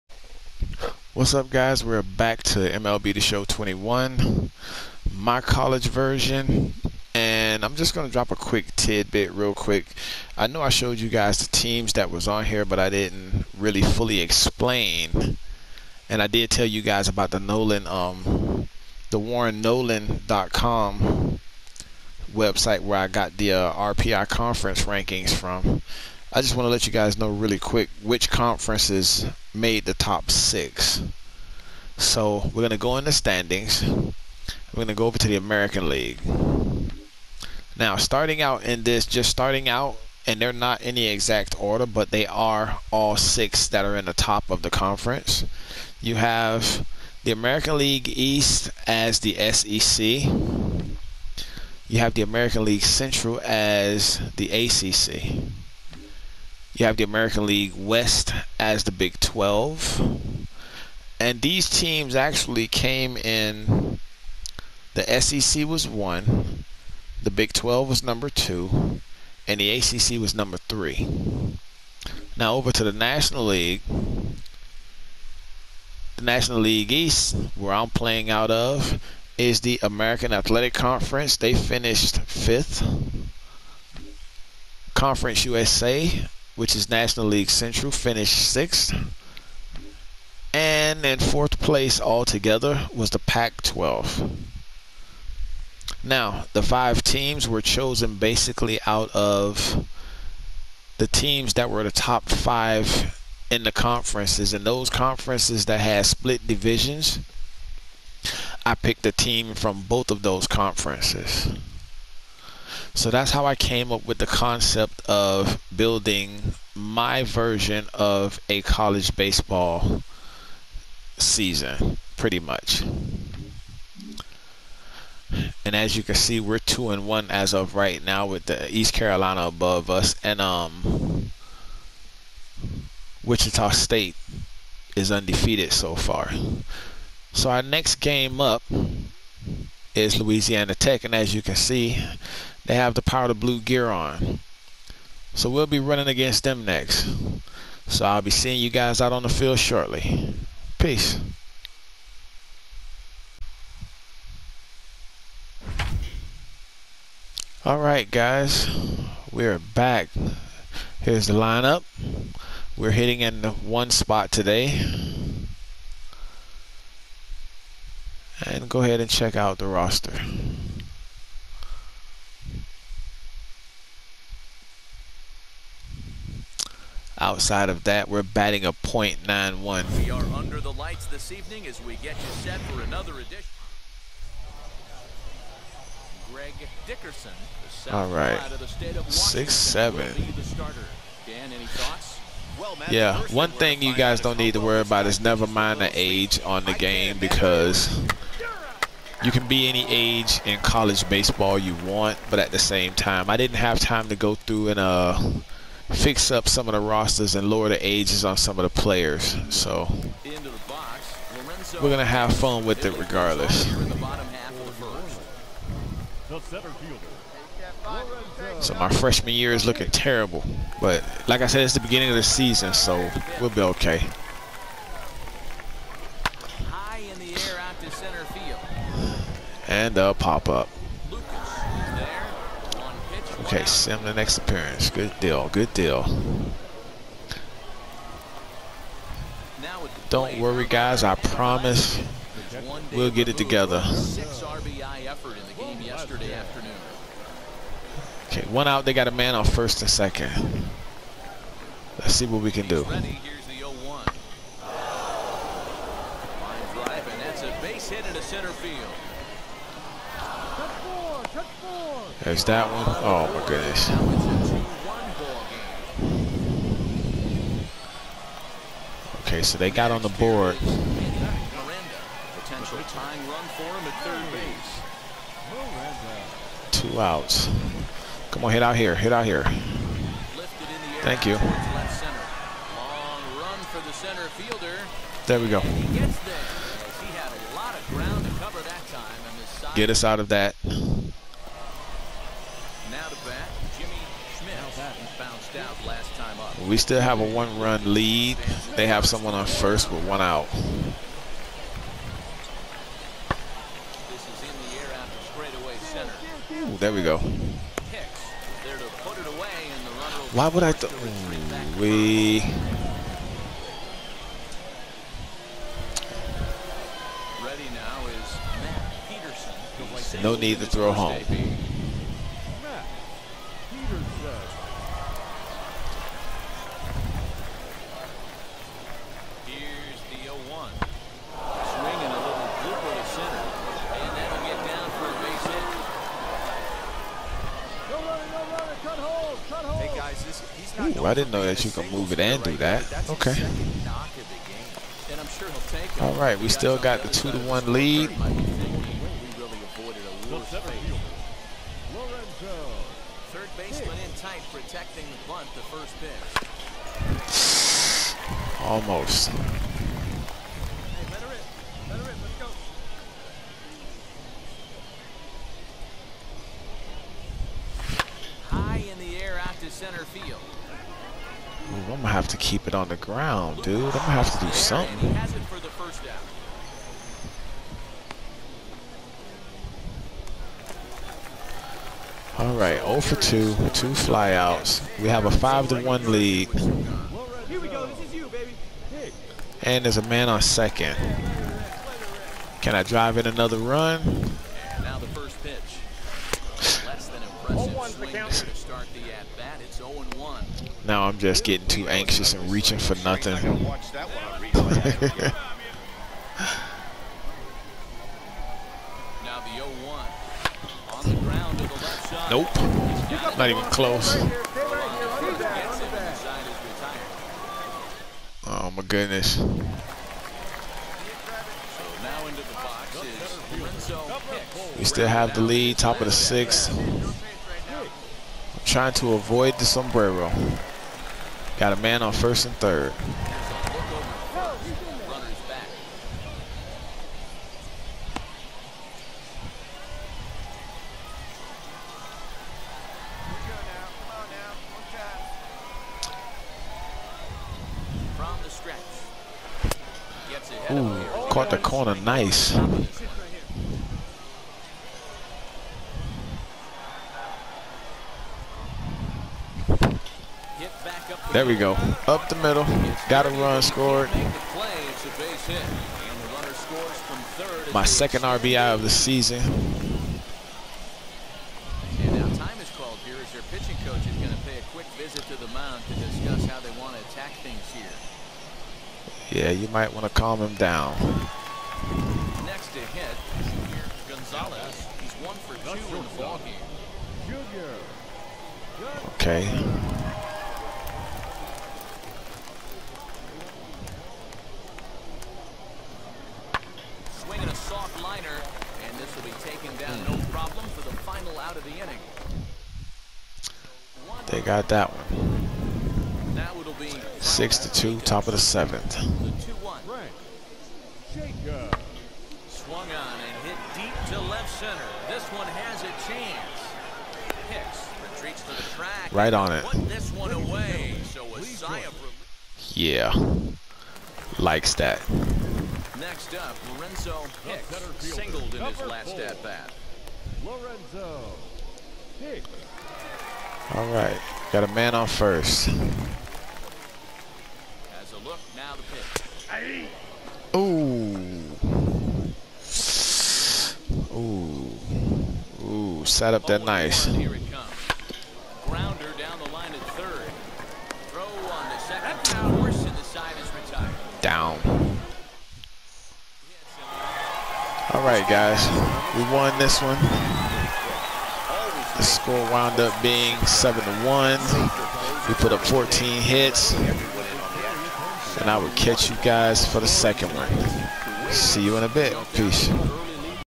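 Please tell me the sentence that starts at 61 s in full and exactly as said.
And these teams actually came in.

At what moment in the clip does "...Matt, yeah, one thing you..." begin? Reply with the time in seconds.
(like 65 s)
192 s.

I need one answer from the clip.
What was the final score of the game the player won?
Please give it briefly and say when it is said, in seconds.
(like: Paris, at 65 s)
7 to 1, at 563 s.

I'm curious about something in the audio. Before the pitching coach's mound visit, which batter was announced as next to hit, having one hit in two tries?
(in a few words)
Gonzalez.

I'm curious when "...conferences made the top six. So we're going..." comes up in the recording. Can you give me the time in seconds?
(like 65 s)
28 s.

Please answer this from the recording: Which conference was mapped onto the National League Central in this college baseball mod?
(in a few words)
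Conference USA.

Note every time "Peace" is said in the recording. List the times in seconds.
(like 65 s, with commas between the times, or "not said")
150 s, 572 s.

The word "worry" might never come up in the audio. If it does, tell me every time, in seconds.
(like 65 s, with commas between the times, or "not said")
194 s, 240 s.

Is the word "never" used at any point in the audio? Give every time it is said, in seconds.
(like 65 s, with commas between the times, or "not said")
195 s.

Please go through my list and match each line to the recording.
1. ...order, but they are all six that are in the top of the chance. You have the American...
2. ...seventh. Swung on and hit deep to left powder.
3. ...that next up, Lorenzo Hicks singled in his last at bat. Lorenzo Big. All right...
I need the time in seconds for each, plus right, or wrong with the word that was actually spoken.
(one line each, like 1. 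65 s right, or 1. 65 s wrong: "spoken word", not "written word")
1. 41 s wrong: "conference", not "chance"
2. 508 s wrong: "center", not "powder"
3. 524 s wrong: "Hicks", not "Big".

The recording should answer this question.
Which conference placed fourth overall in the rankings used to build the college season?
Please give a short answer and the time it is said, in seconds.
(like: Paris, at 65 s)
Pac 12, at 93 s.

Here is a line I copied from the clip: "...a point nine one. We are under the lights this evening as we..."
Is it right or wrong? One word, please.
right.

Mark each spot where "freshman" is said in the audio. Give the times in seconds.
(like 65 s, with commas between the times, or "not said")
218 s.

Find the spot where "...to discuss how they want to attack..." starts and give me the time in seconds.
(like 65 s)
475 s.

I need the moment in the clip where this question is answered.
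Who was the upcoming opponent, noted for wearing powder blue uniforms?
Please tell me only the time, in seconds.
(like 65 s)
140 s.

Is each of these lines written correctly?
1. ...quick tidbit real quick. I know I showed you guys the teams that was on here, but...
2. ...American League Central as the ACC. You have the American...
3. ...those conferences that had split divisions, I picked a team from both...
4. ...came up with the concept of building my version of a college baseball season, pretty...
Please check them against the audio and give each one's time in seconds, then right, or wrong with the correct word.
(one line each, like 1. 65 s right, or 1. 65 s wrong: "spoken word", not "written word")
1. 8 s right
2. 52 s right
3. 104 s right
4. 113 s right.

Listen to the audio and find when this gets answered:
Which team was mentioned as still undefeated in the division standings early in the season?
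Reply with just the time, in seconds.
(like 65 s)
133 s.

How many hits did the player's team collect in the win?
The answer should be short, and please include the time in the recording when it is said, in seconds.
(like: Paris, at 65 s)
14, at 565 s.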